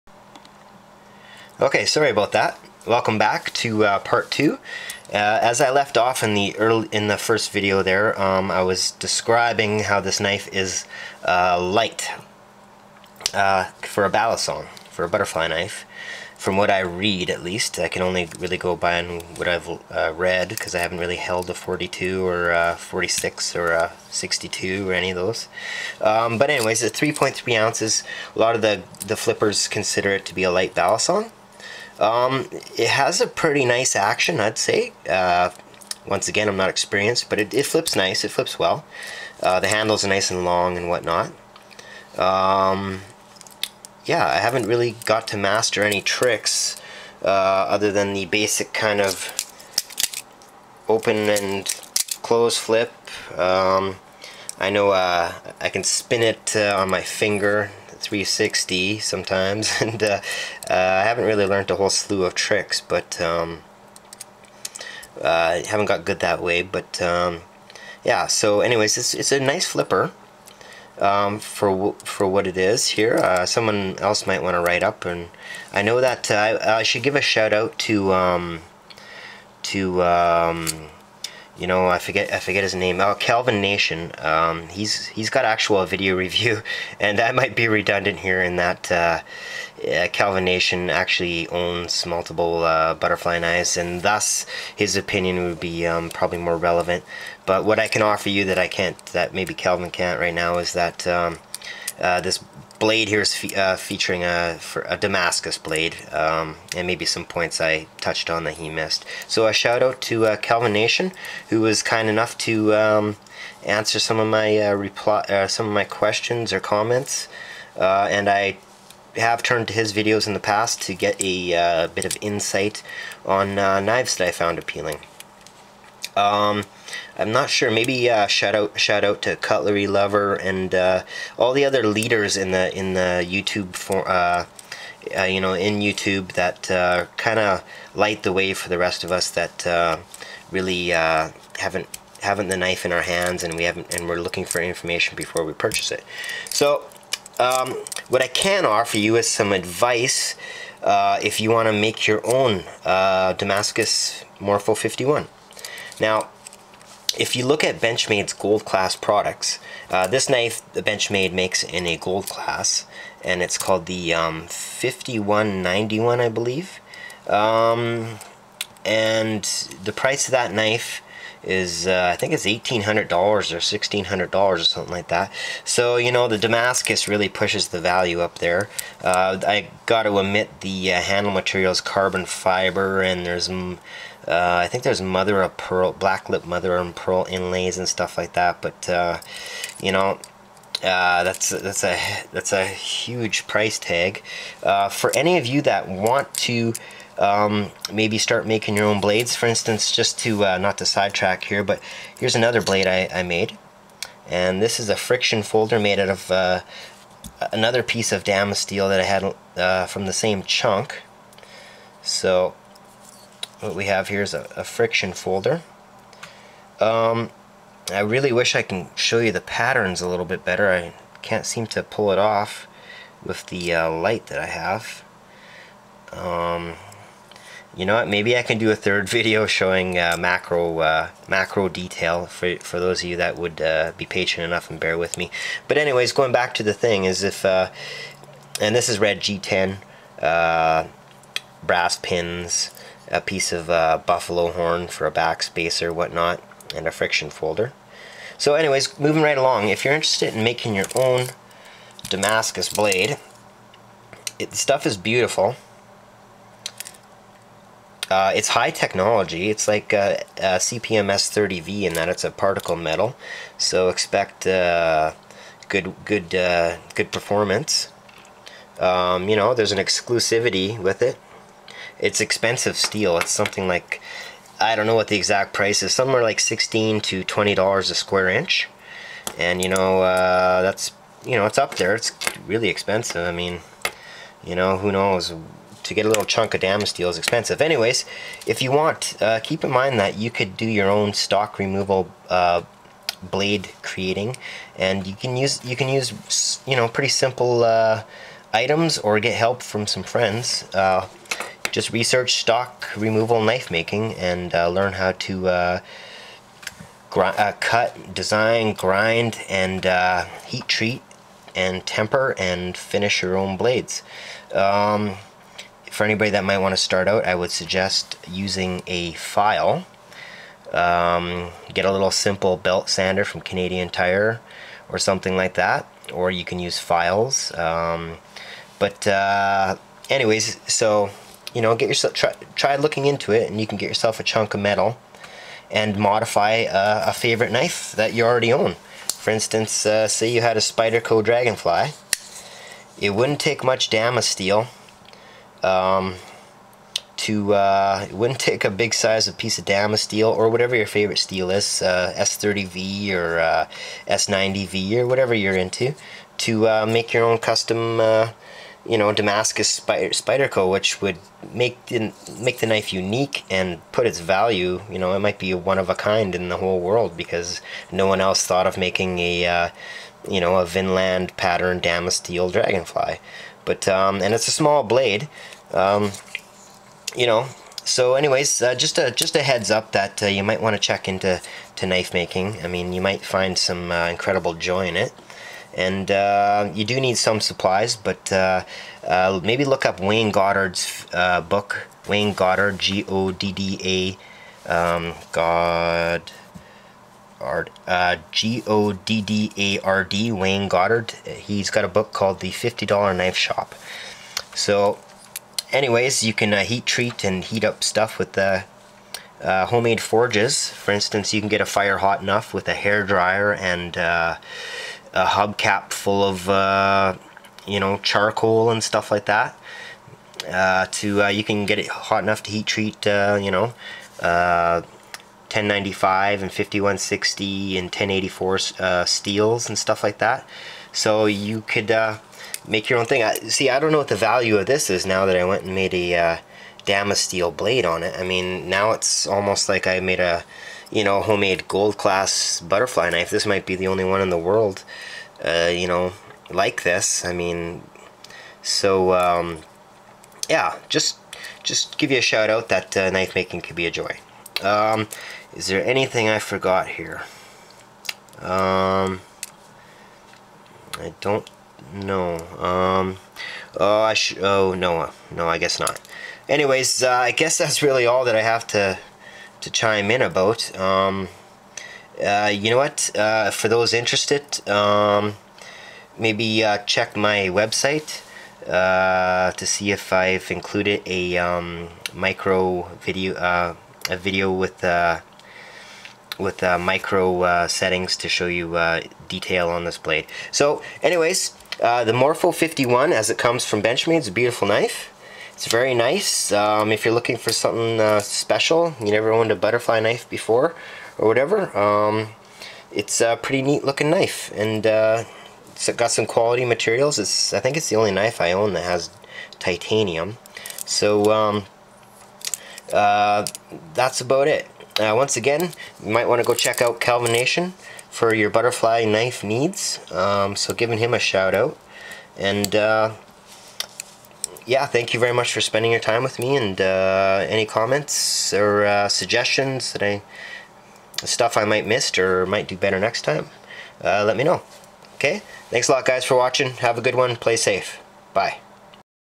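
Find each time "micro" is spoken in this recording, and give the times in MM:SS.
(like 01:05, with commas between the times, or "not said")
08:02, 08:06.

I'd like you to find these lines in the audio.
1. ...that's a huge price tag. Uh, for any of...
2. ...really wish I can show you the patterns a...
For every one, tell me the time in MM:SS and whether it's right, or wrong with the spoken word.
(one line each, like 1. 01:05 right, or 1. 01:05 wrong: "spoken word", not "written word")
1. 03:12 right
2. 03:37 right.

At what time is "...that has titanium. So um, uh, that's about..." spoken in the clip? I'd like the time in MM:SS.
08:28.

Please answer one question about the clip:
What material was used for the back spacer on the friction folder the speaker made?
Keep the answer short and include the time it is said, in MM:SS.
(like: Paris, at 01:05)
Buffalo horn, at 04:04.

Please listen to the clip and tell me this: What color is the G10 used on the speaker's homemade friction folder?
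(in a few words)
Red.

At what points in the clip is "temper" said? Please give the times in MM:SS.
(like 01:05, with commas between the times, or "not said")
05:11.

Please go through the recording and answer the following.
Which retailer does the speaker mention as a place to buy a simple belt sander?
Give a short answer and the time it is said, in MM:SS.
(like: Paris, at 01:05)
Canadian Tire, at 05:23.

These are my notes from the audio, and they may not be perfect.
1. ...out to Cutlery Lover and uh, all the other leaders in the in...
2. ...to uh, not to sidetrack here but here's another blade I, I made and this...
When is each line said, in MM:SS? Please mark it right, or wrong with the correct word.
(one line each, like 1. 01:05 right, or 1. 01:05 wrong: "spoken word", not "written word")
1. 02:09 right
2. 03:20 right.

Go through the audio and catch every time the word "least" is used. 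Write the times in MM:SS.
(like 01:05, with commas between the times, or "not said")
00:17.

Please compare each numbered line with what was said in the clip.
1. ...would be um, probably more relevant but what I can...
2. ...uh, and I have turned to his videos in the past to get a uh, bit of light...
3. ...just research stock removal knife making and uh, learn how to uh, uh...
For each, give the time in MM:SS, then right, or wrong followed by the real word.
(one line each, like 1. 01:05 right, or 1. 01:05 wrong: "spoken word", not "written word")
1. 01:35 right
2. 01:57 wrong: "insight", not "light"
3. 05:01 right.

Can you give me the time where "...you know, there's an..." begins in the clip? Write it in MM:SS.
04:29.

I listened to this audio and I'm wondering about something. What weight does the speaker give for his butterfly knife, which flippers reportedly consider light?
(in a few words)
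3.3 ounces.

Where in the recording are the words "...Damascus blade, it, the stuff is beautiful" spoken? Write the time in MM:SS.
04:12.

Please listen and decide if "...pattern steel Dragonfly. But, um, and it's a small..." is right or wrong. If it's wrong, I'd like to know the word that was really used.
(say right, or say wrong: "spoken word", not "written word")
right.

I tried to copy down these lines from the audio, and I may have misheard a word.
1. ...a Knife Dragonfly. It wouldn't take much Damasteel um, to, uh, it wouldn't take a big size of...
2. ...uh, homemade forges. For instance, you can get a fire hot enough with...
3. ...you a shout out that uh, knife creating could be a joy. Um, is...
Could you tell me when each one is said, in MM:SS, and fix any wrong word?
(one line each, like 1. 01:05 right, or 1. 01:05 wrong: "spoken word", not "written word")
1. 05:40 wrong: "Spyderco", not "Knife"
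2. 06:49 right
3. 07:32 wrong: "making", not "creating".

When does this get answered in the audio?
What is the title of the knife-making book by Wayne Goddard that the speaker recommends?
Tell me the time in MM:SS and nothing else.
06:42.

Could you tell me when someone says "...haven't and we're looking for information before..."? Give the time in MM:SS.
02:23.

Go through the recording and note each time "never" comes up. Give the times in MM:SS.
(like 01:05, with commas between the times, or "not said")
08:19.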